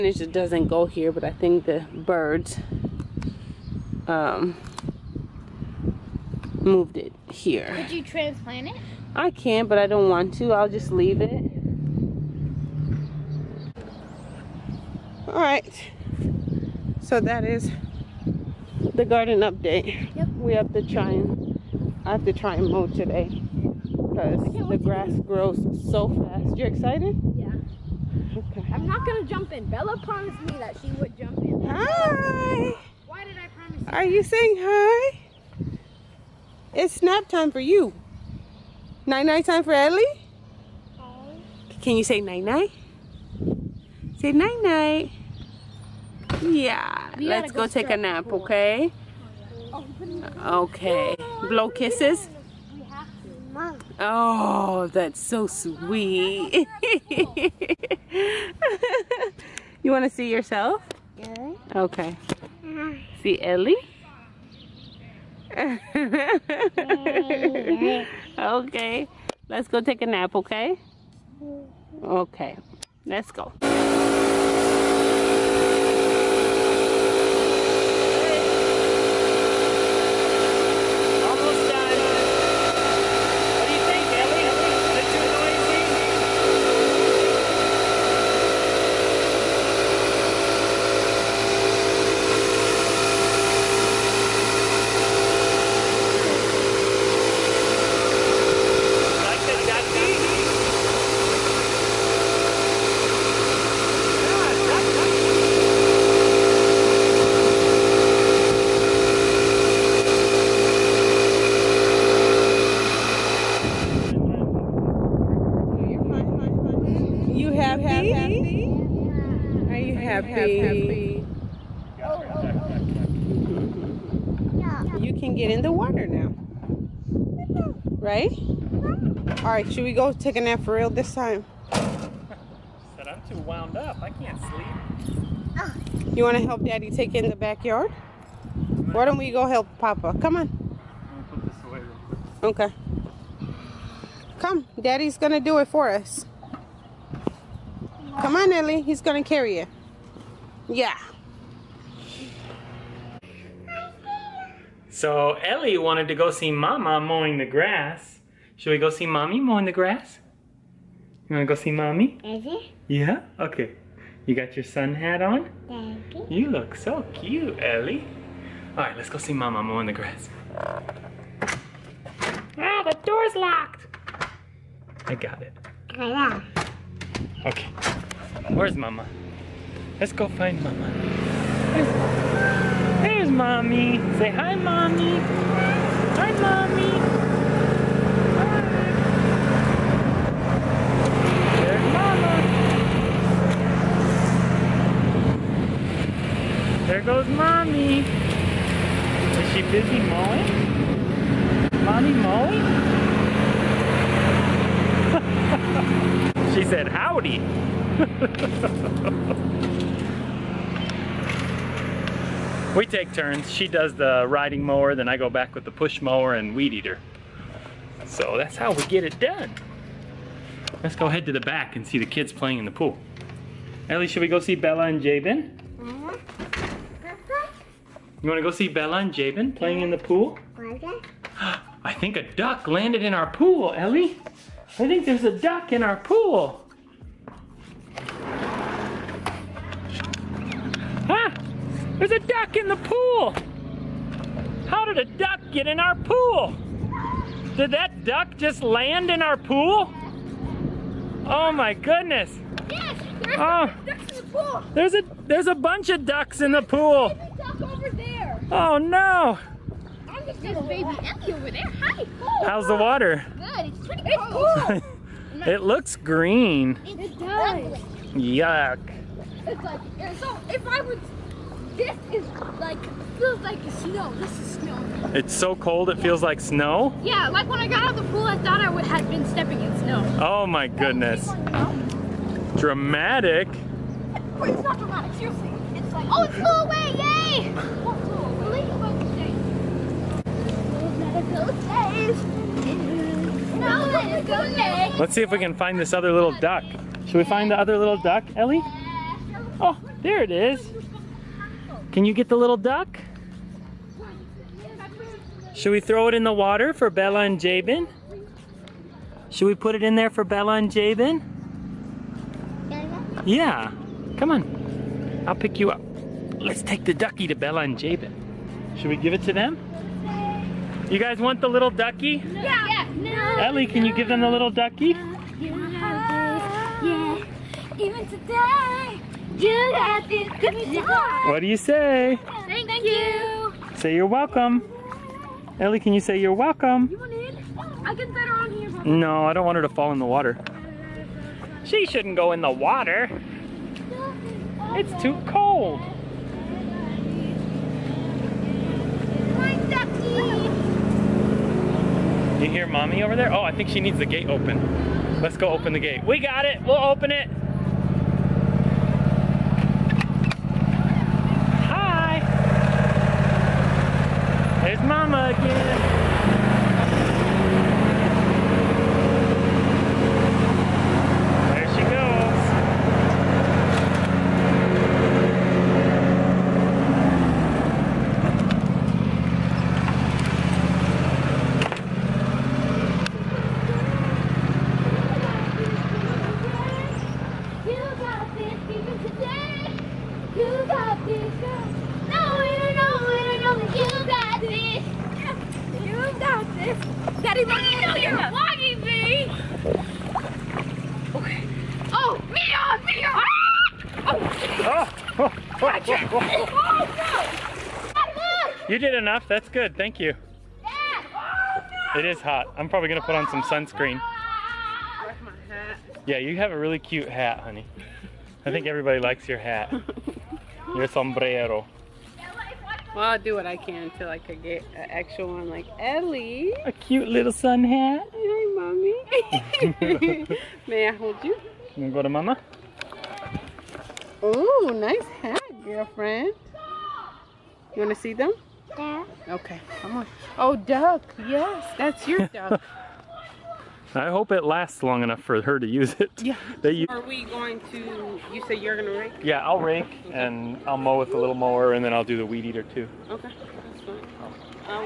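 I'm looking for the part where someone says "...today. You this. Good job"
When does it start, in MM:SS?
05:28.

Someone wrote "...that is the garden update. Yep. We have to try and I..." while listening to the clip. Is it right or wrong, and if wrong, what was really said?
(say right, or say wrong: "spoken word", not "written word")
right.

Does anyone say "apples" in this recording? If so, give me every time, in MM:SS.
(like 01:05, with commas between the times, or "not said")
not said.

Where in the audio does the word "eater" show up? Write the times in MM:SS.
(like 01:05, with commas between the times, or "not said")
03:36, 07:32.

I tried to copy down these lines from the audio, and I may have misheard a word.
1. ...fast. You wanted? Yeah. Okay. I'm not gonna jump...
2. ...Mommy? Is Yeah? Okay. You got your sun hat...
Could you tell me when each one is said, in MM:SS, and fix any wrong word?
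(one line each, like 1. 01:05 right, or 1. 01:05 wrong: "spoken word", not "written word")
1. 00:26 wrong: "excited", not "wanted"
2. 02:41 right.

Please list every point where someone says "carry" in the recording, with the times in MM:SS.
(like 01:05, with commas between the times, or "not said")
02:29.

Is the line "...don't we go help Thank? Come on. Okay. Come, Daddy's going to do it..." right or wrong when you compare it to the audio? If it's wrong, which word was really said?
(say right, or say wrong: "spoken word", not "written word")
wrong: "Papa", not "Thank".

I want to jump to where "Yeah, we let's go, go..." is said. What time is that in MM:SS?
00:46.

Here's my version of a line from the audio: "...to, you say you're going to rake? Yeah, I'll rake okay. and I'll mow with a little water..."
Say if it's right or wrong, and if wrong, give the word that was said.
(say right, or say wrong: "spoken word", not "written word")
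wrong: "mower", not "water".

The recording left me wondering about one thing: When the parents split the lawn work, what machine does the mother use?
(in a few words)
Riding mower.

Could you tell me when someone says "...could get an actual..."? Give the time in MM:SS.
07:04.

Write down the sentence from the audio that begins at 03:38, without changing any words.
So that's how we get it done.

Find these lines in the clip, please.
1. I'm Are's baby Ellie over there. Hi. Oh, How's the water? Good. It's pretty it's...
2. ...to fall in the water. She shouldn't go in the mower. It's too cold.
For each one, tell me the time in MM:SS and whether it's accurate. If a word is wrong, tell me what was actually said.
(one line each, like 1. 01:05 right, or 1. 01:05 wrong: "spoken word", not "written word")
1. 04:20 wrong: "There", not "Are"
2. 05:39 wrong: "water", not "mower".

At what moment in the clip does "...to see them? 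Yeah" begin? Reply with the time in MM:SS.
07:17.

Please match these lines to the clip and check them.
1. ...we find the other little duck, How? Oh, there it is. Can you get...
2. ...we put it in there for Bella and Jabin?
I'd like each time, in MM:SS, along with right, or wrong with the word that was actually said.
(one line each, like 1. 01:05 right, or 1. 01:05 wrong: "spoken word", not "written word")
1. 04:57 wrong: "Ellie", not "How"
2. 05:09 right.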